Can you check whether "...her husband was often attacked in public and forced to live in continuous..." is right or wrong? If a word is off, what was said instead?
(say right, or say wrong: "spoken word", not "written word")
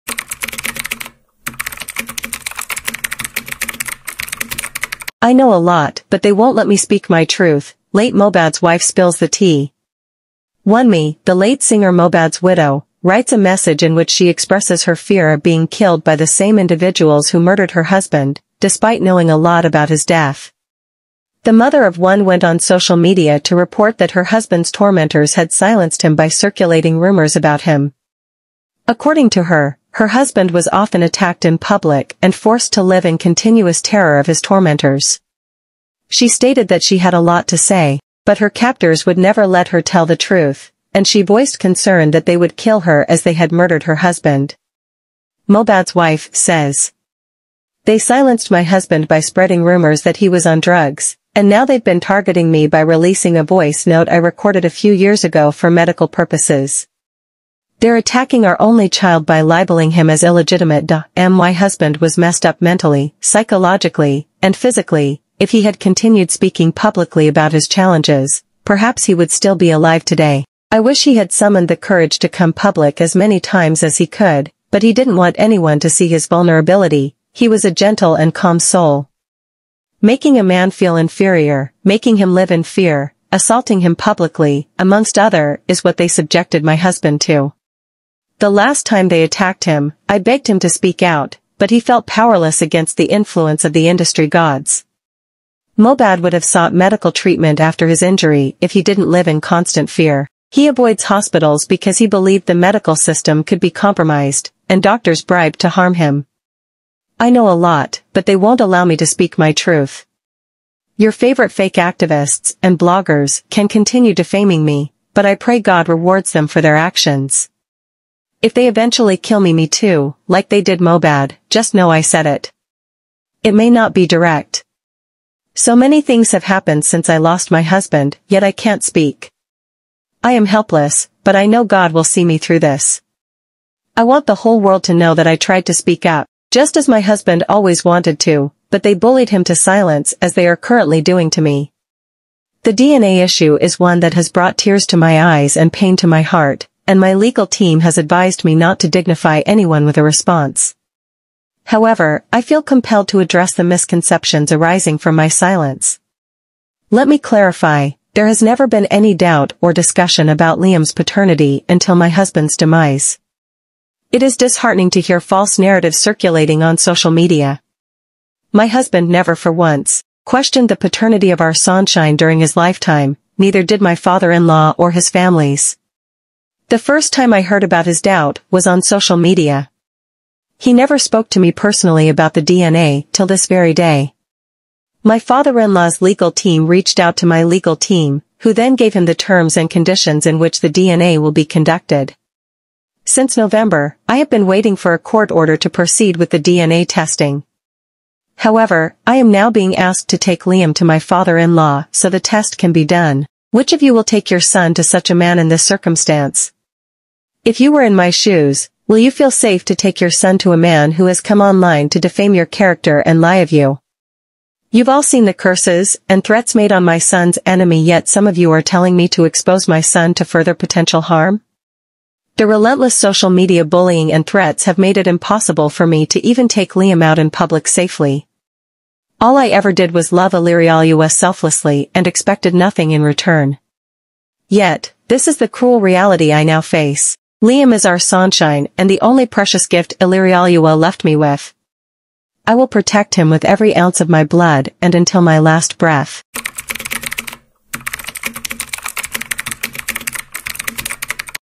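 right.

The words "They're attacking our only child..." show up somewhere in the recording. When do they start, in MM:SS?
00:57.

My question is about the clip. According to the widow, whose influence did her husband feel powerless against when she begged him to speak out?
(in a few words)
The industry gods.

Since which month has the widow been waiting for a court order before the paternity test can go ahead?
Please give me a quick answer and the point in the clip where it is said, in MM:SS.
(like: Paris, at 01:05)
November, at 03:13.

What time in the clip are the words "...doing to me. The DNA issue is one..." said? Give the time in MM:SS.
02:21.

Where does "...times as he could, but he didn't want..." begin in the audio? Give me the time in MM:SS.
01:13.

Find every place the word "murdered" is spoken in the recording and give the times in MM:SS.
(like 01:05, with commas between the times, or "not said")
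00:17, 00:43.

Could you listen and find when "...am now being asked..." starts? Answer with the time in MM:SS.
03:19.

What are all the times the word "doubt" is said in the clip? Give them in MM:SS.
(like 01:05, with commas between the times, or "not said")
02:39, 02:58.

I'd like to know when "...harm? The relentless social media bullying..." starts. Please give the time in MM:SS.
03:41.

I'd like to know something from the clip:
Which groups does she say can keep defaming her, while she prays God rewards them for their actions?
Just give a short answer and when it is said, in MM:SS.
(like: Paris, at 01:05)
Fake activists and bloggers, at 01:51.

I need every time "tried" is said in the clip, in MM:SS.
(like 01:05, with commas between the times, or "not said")
02:15.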